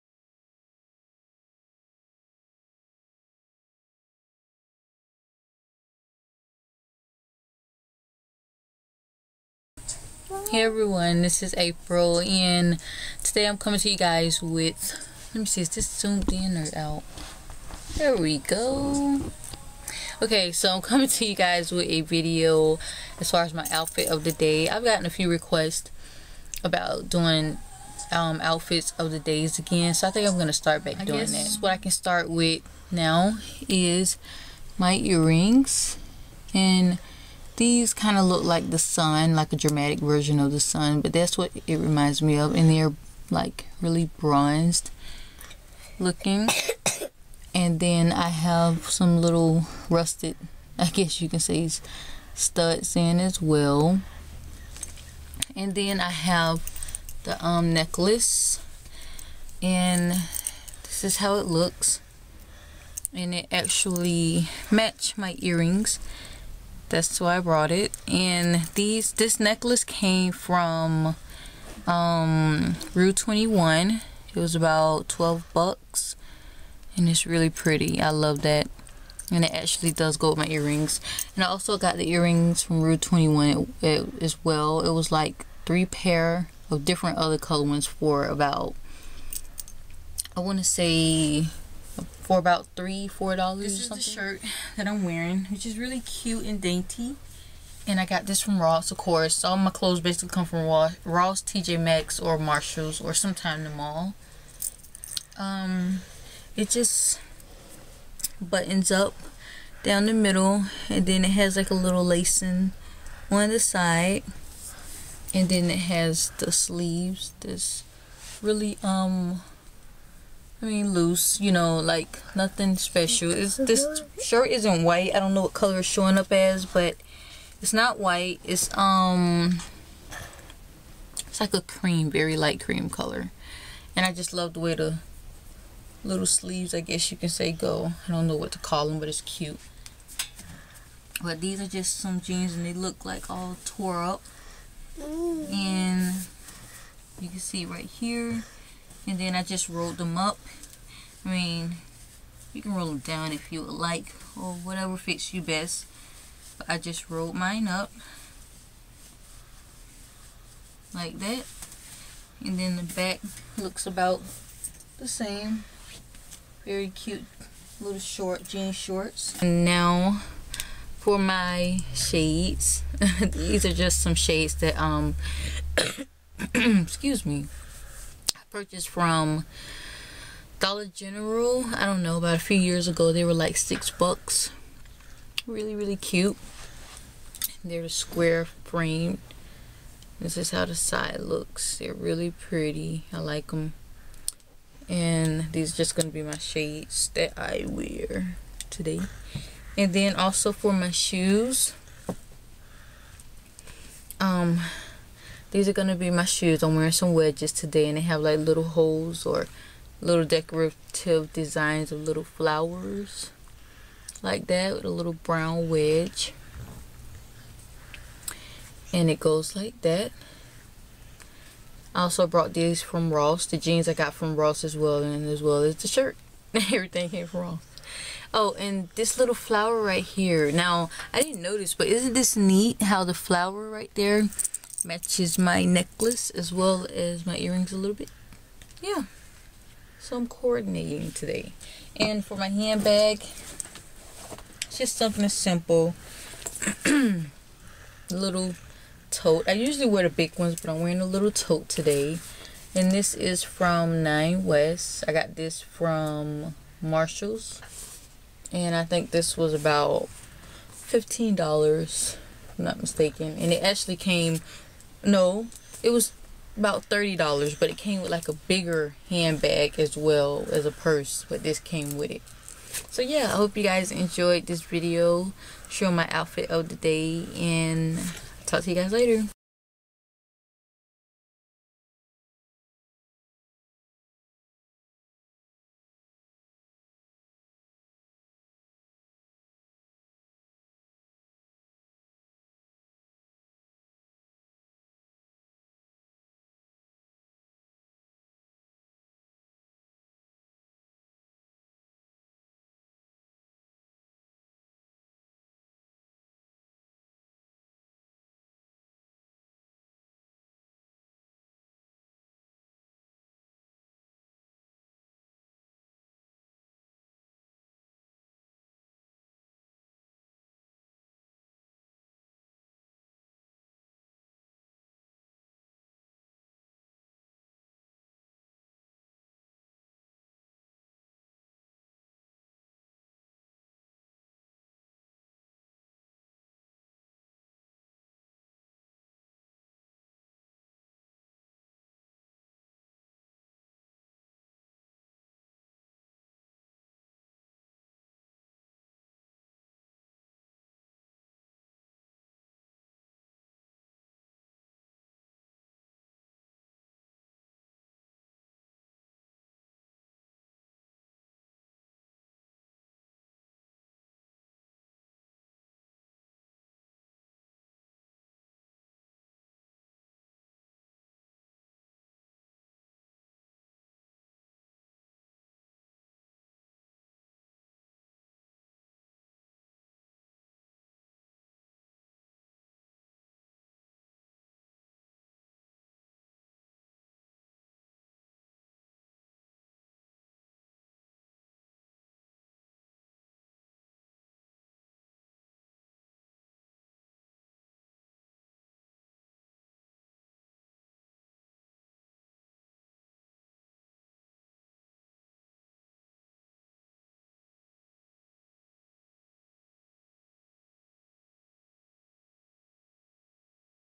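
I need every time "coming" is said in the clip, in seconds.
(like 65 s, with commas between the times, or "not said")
13 s, 20 s.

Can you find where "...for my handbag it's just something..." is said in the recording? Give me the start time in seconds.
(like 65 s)
242 s.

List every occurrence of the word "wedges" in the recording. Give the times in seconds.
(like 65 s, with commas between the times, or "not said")
207 s, 215 s.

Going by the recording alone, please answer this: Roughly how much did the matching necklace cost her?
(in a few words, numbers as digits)
$12.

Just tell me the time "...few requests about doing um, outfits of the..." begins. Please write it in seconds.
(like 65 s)
25 s.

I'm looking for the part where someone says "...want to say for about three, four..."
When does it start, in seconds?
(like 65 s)
90 s.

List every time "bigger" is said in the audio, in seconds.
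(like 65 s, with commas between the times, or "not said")
268 s.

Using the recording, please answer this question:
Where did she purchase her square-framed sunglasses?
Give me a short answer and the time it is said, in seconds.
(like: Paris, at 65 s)
Dollar General, at 180 s.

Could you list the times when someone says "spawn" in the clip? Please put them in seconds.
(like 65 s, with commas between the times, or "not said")
not said.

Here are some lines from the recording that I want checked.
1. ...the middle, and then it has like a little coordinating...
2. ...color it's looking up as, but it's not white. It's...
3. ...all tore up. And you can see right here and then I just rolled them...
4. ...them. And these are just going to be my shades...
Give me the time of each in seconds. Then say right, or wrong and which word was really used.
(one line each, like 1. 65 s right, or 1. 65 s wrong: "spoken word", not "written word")
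1. 110 s wrong: "lacing", not "coordinating"
2. 125 s wrong: "showing", not "looking"
3. 143 s right
4. 193 s right.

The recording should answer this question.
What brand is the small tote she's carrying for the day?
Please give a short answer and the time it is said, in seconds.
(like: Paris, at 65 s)
Nine West, at 254 s.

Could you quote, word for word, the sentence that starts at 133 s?
And I just love the way the little sleeves, I guess you can say, go.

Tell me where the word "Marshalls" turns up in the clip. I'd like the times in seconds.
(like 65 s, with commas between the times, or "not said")
102 s, 256 s.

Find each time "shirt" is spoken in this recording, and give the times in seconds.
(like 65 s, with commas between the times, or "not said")
94 s, 124 s, 225 s.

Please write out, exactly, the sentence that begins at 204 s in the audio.
Um, these are going to be my shoes.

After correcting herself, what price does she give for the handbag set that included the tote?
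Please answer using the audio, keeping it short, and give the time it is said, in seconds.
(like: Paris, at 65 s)
$30, at 266 s.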